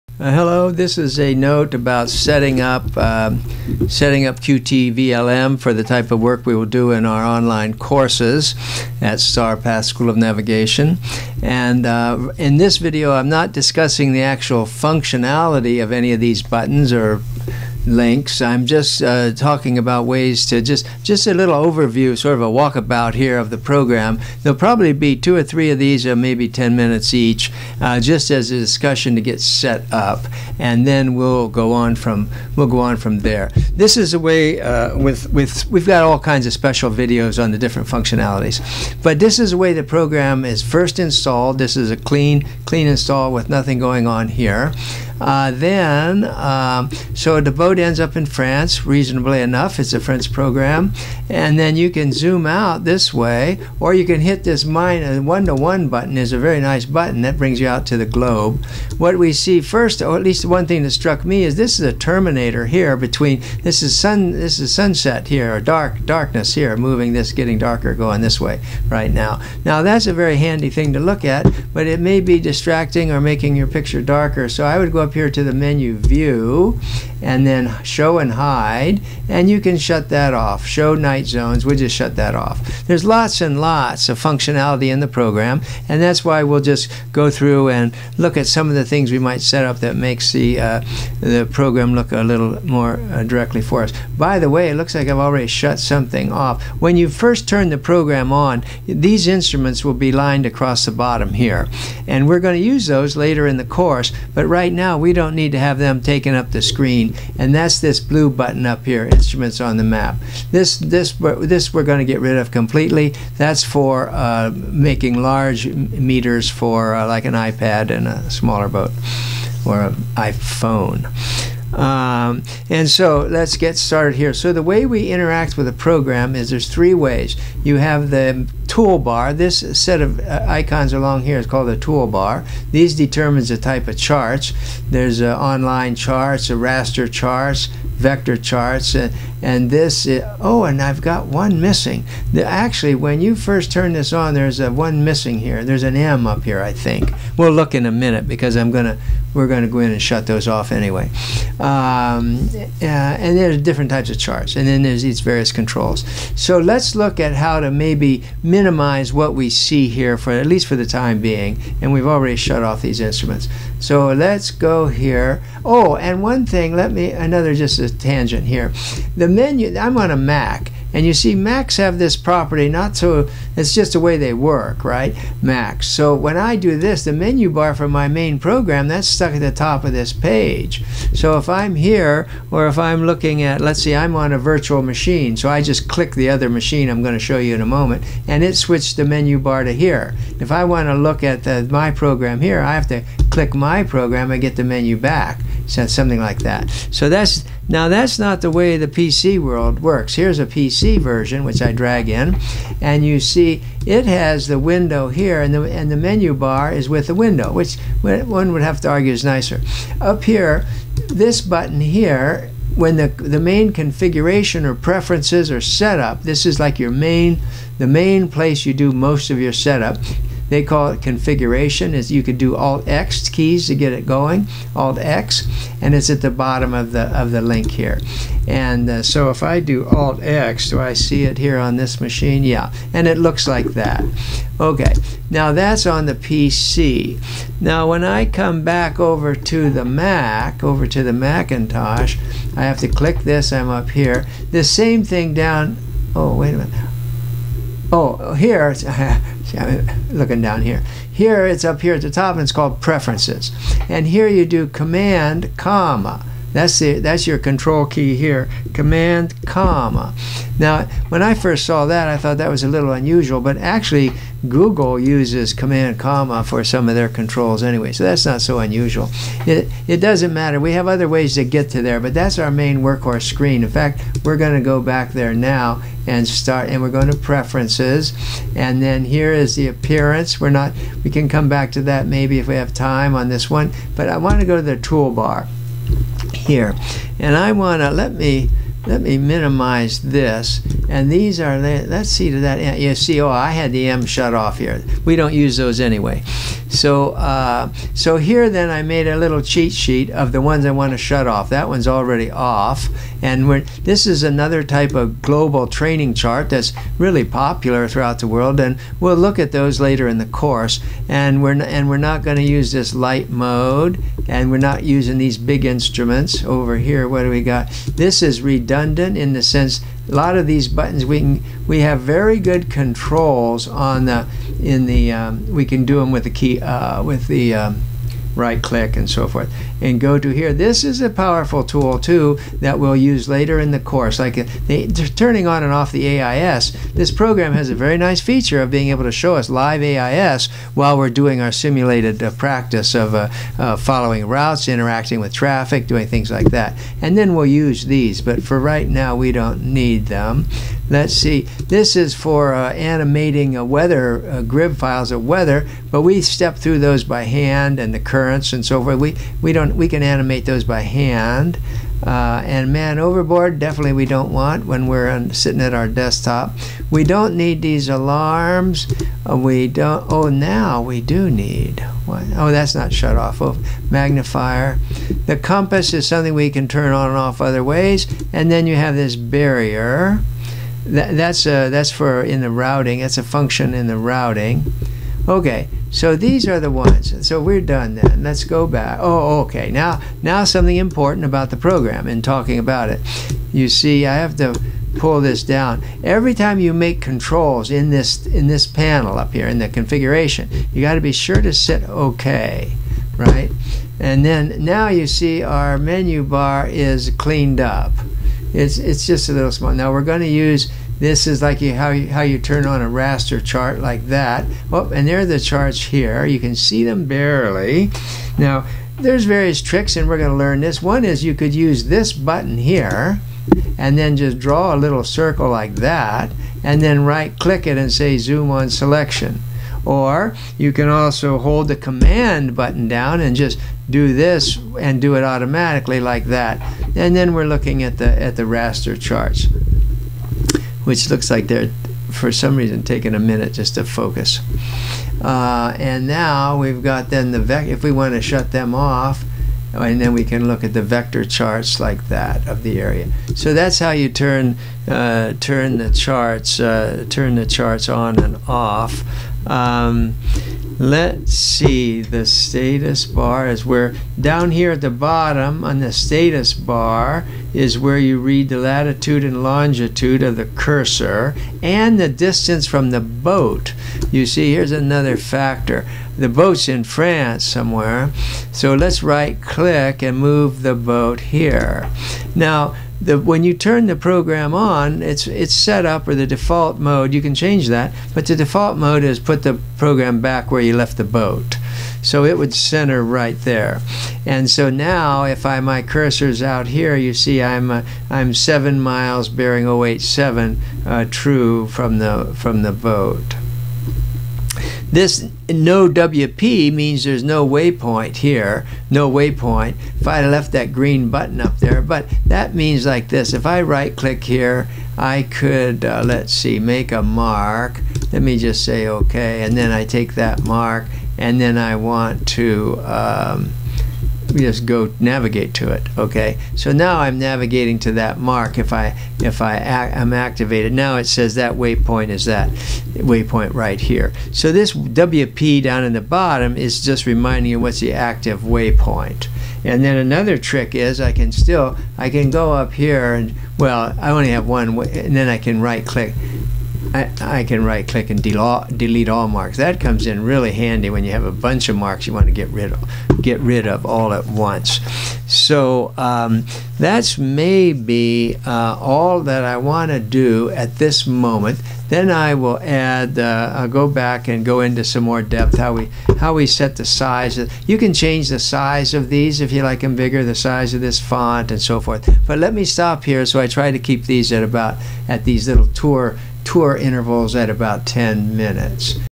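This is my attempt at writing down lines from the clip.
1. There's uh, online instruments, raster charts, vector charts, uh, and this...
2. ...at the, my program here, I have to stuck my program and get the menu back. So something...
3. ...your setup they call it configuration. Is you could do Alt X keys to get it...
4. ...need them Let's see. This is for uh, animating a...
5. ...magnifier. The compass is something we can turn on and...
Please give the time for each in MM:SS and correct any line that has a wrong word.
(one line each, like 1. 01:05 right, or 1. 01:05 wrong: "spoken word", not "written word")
1. 02:14 wrong: "charts", not "instruments"
2. 03:11 wrong: "click", not "stuck"
3. 03:39 right
4. 05:49 right
5. 06:13 right.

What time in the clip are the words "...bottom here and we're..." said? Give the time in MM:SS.
01:40.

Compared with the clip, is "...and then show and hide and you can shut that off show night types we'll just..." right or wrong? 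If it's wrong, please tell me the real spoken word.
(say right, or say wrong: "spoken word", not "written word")
wrong: "zones", not "types".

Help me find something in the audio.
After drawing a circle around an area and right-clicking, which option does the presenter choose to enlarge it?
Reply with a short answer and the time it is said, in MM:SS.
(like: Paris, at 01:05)
Zoom on selection, at 07:08.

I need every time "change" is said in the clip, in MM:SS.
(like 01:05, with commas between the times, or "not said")
08:07, 09:27.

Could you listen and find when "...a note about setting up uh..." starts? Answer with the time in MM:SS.
00:01.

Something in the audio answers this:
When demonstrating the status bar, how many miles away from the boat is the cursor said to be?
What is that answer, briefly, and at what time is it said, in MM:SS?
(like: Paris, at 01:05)
7, at 08:18.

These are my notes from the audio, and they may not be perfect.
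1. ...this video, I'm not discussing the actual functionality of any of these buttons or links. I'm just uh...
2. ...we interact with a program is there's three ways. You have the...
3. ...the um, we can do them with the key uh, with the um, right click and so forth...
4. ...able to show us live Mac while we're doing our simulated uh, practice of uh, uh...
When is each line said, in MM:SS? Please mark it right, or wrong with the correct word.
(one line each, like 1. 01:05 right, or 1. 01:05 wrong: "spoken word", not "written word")
1. 00:12 right
2. 02:04 right
3. 05:24 right
4. 05:38 wrong: "AIS", not "Mac".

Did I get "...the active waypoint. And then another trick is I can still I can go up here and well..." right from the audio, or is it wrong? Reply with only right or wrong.
right.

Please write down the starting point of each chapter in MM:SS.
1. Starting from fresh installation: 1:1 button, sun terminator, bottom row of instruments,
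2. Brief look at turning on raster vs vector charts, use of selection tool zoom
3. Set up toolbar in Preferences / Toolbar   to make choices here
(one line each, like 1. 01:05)
1. 00:33
2. 06:48
3. 04:31.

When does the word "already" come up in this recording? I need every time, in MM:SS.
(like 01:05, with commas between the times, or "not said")
01:35, 02:42, 05:01.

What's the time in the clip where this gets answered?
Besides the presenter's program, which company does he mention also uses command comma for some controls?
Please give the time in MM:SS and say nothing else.
04:24.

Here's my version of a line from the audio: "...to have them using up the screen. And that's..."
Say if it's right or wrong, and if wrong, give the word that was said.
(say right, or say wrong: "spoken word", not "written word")
wrong: "taking", not "using".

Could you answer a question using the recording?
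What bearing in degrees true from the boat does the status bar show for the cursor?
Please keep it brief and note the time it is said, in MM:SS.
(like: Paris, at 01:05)
087, at 08:19.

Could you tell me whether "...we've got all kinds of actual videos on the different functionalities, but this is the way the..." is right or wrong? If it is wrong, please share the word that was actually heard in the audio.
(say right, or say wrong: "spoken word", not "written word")
wrong: "special", not "actual".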